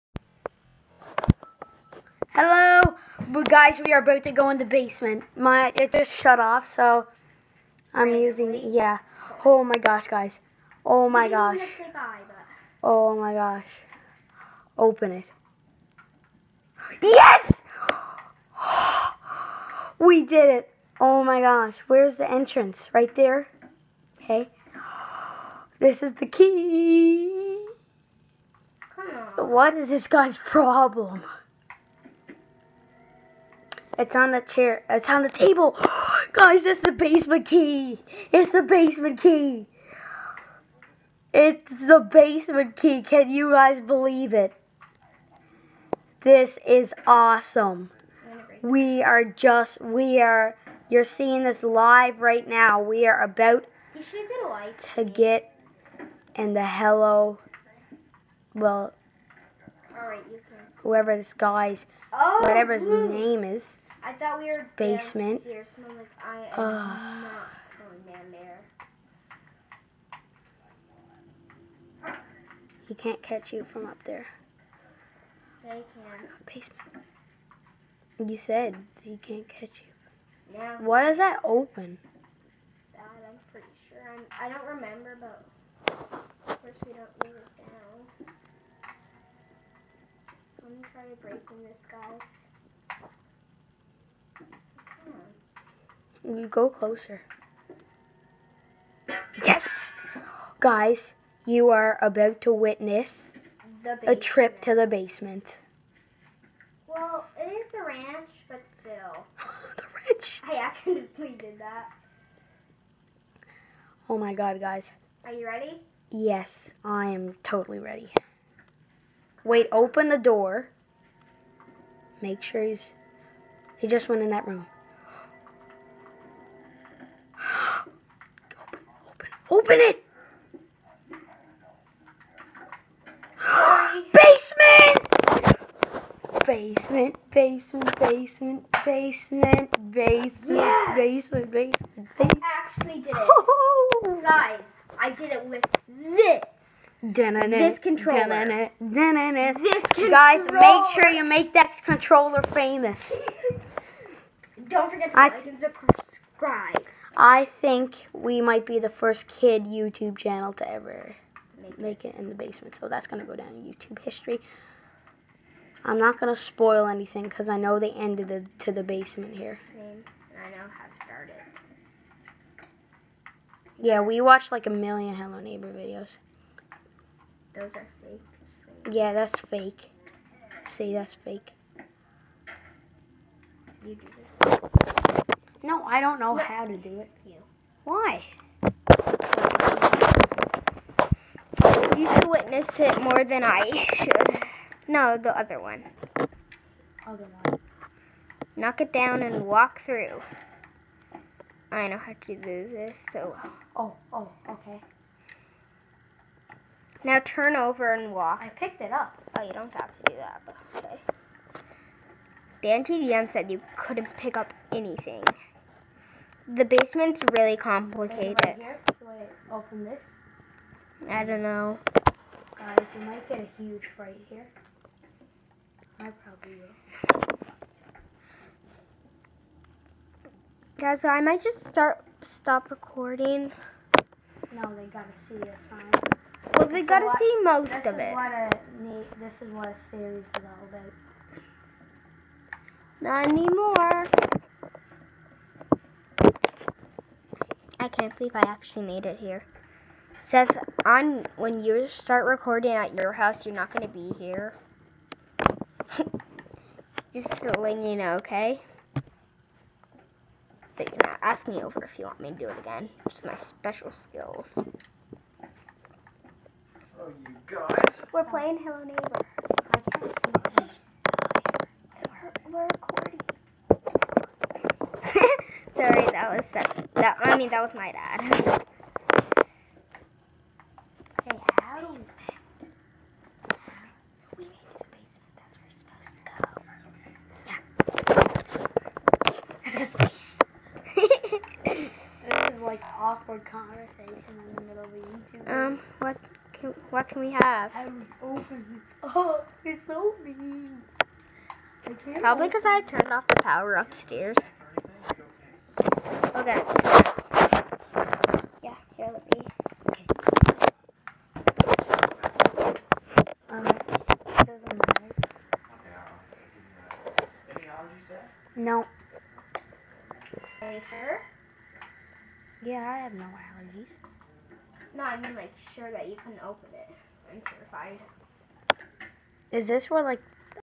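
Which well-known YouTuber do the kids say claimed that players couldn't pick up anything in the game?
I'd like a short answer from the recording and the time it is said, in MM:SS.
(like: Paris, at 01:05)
Dan TDM, at 03:32.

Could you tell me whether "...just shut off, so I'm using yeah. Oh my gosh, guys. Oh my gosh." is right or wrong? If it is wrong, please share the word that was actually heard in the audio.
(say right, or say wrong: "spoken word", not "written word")
right.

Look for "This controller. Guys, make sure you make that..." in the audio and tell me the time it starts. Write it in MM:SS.
02:28.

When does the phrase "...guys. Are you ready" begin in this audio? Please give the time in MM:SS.
01:54.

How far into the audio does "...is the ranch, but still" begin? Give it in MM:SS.
01:47.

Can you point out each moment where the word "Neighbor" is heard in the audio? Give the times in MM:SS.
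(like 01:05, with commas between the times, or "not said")
02:55, 04:28.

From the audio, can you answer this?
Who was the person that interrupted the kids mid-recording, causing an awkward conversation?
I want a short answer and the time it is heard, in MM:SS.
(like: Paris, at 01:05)
my dad, at 04:37.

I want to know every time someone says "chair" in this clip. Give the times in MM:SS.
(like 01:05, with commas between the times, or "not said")
00:34.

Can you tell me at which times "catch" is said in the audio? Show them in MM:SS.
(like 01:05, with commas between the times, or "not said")
01:13, 01:19.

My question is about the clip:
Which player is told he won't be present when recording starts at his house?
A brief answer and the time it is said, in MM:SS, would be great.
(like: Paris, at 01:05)
Seth, at 04:10.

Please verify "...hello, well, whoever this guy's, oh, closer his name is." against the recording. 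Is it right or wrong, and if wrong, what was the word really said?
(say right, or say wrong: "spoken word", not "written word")
wrong: "whatever", not "closer".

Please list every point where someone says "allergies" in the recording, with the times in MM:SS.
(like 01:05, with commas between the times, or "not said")
05:17, 05:23.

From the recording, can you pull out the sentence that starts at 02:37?
I think we might be the first kid YouTube channel to ever make, make it in the basement.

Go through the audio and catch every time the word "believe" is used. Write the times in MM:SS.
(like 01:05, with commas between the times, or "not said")
00:43, 04:08.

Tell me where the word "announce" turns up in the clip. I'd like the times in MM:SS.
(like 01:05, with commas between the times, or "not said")
not said.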